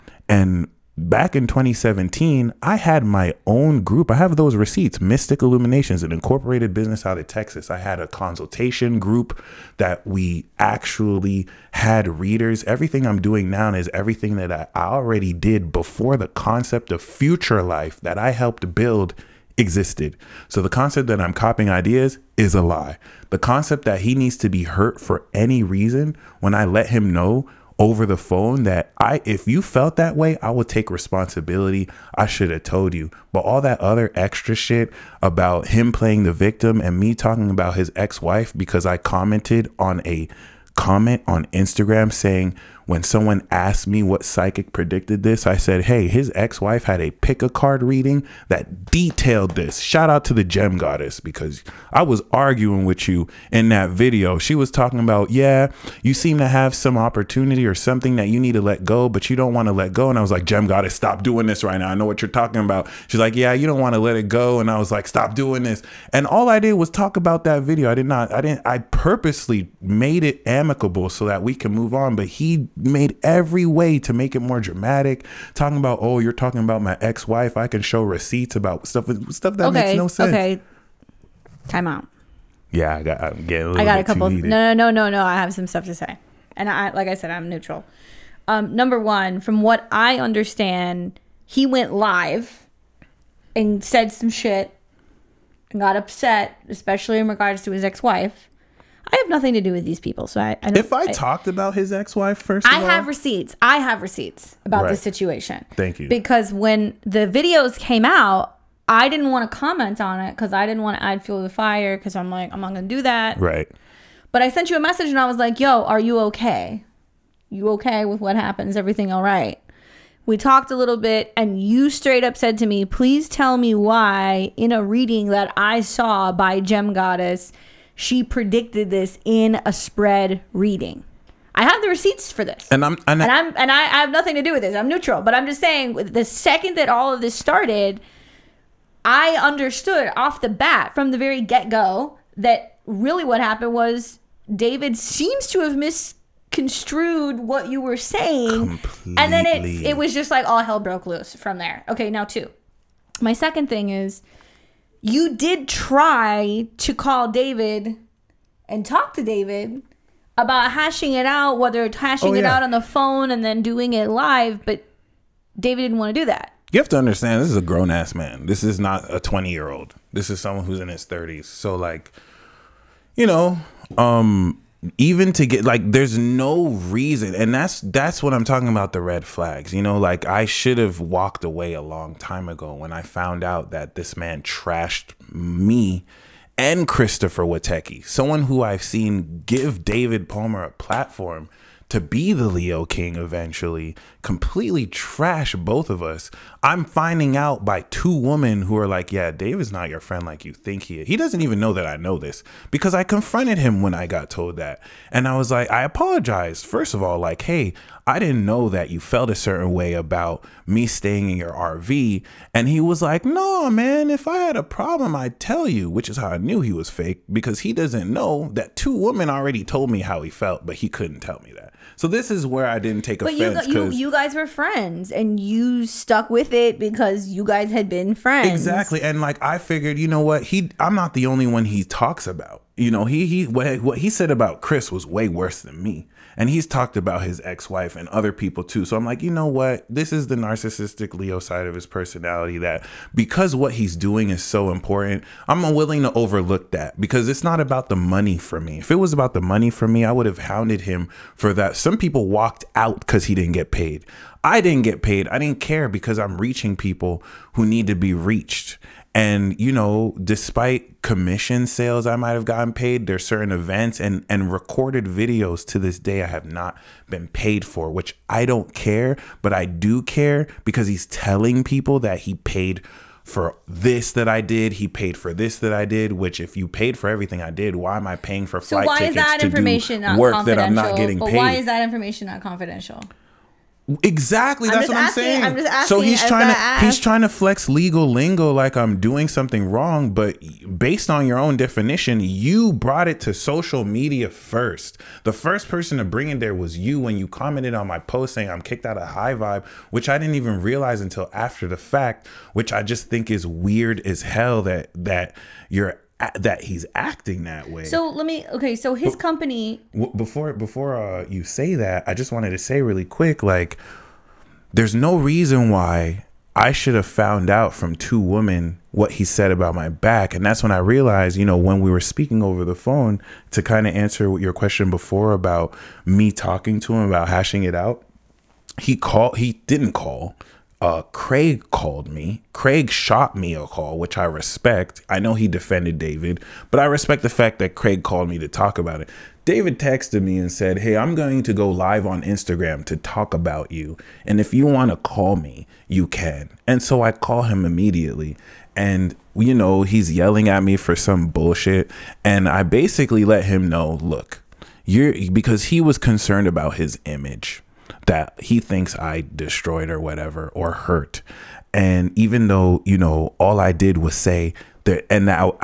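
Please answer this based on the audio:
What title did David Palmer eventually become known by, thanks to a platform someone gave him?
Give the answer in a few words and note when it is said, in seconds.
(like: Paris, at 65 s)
the Leo King, at 192 s.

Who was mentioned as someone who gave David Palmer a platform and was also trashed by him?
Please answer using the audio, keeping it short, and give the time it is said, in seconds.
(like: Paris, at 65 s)
Christopher Watecki, at 186 s.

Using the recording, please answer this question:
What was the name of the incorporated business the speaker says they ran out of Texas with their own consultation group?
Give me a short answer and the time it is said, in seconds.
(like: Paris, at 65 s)
Mystic Illuminations, at 5 s.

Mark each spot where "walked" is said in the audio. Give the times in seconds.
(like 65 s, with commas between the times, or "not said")
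181 s, 252 s.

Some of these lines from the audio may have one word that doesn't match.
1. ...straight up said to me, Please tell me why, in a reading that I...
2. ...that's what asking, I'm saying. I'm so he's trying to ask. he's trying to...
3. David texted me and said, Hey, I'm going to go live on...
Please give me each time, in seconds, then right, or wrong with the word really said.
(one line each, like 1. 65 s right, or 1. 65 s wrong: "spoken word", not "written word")
1. 121 s right
2. 284 s right
3. 339 s right.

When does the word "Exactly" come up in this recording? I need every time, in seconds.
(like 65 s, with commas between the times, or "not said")
228 s, 284 s.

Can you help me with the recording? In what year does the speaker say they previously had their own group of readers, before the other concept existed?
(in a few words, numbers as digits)
2017.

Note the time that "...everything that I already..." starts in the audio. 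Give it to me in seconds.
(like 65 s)
13 s.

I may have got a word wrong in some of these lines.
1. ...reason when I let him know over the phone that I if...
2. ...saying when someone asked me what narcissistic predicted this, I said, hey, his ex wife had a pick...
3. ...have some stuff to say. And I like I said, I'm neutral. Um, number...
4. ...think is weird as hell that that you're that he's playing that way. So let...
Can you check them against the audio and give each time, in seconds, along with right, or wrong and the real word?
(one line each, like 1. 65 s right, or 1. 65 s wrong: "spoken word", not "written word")
1. 25 s right
2. 42 s wrong: "psychic", not "narcissistic"
3. 85 s right
4. 303 s wrong: "acting", not "playing".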